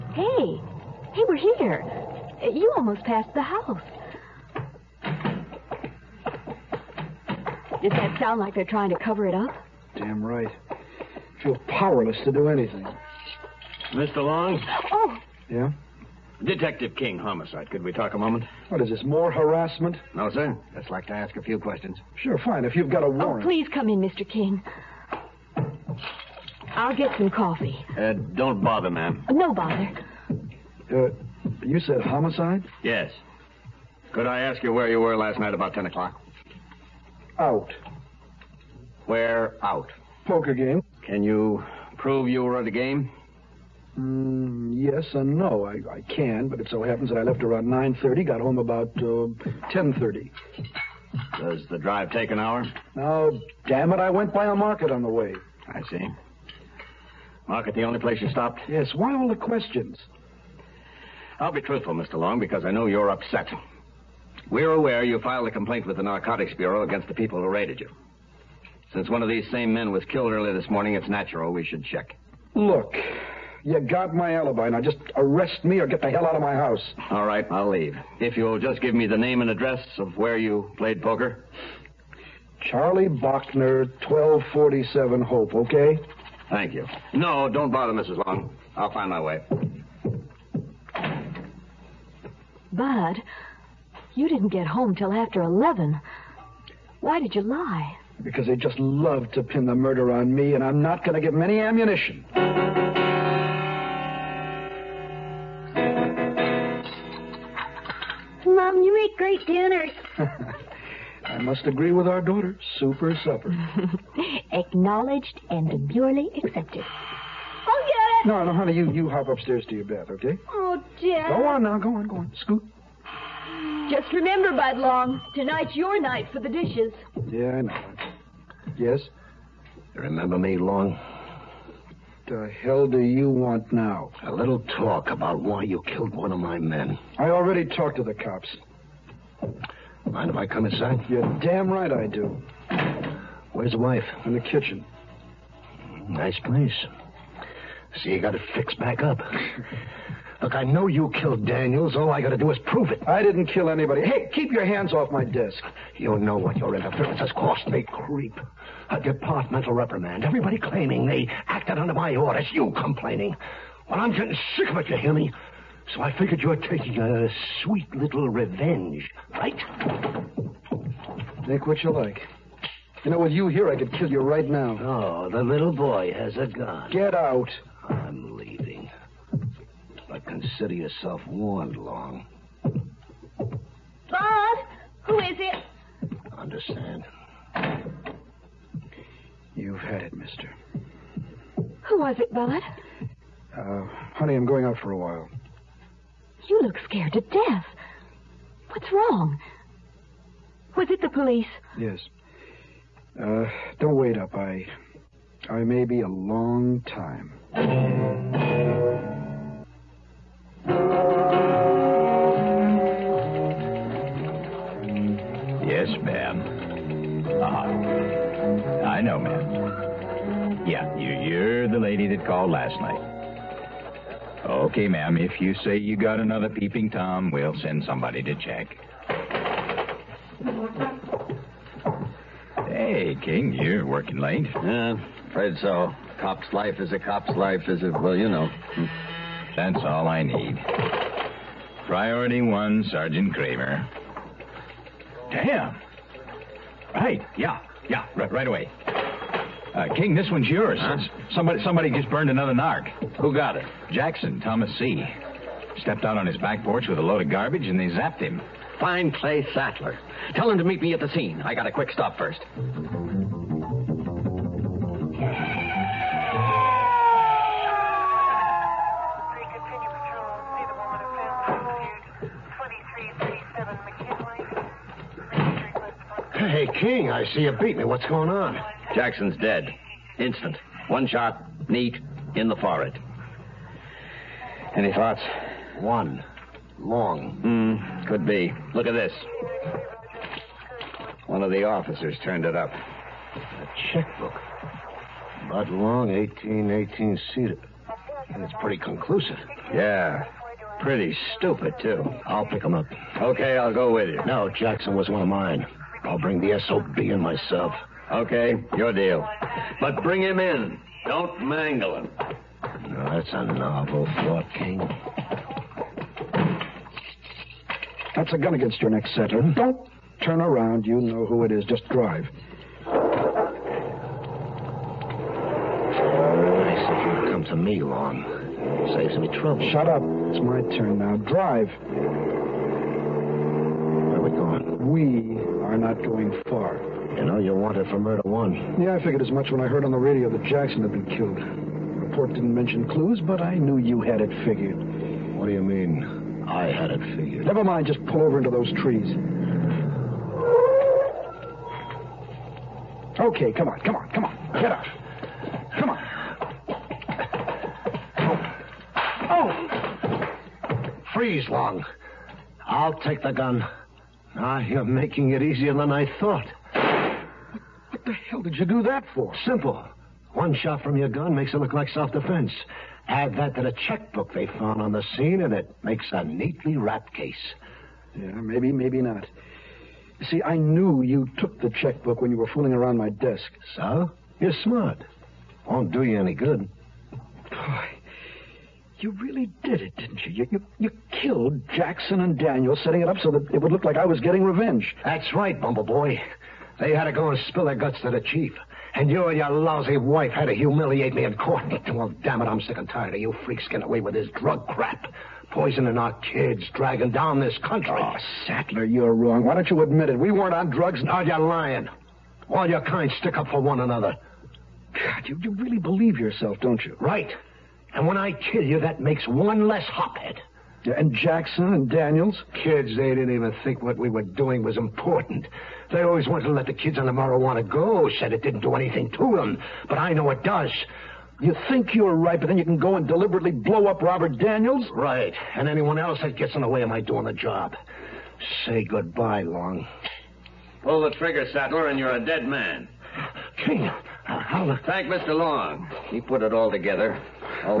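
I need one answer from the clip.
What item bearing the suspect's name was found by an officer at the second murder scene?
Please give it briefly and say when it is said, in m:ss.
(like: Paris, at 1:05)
A checkbook, at 4:52.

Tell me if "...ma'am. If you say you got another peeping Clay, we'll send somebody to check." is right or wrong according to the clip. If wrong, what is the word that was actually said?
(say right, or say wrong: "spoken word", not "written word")
wrong: "Tom", not "Clay".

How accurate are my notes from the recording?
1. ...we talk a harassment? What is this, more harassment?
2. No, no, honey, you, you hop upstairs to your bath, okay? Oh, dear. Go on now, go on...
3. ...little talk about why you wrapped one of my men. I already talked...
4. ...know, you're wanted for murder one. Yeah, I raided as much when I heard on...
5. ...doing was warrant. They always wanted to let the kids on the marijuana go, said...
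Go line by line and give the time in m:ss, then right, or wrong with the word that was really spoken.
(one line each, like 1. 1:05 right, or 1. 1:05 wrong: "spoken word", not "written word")
1. 0:17 wrong: "moment", not "harassment"
2. 1:58 right
3. 2:14 wrong: "killed", not "wrapped"
4. 5:37 wrong: "figured", not "raided"
5. 7:04 wrong: "important", not "warrant".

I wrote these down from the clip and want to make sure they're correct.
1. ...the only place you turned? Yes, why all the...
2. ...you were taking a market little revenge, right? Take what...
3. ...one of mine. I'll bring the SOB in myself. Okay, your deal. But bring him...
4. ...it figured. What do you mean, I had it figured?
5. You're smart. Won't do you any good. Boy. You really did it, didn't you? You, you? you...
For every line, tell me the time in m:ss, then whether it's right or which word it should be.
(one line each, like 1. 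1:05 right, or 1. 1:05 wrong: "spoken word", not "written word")
1. 0:57 wrong: "stopped", not "turned"
2. 2:46 wrong: "sweet", not "market"
3. 5:05 right
4. 5:44 right
5. 6:24 right.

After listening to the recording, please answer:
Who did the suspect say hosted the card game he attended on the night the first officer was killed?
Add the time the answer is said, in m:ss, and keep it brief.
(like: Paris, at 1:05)
Charlie Bochner, at 1:22.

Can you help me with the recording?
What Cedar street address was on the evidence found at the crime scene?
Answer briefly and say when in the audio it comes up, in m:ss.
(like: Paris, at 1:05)
1818 Cedar, at 4:56.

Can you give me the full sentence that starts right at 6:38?
And you and your lousy wife had to humiliate me in court.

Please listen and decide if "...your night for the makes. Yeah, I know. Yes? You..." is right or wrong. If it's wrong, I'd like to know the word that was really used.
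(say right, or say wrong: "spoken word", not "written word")
wrong: "dishes", not "makes".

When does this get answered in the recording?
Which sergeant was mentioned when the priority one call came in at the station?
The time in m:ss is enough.
4:02.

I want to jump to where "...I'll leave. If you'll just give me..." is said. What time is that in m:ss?
1:17.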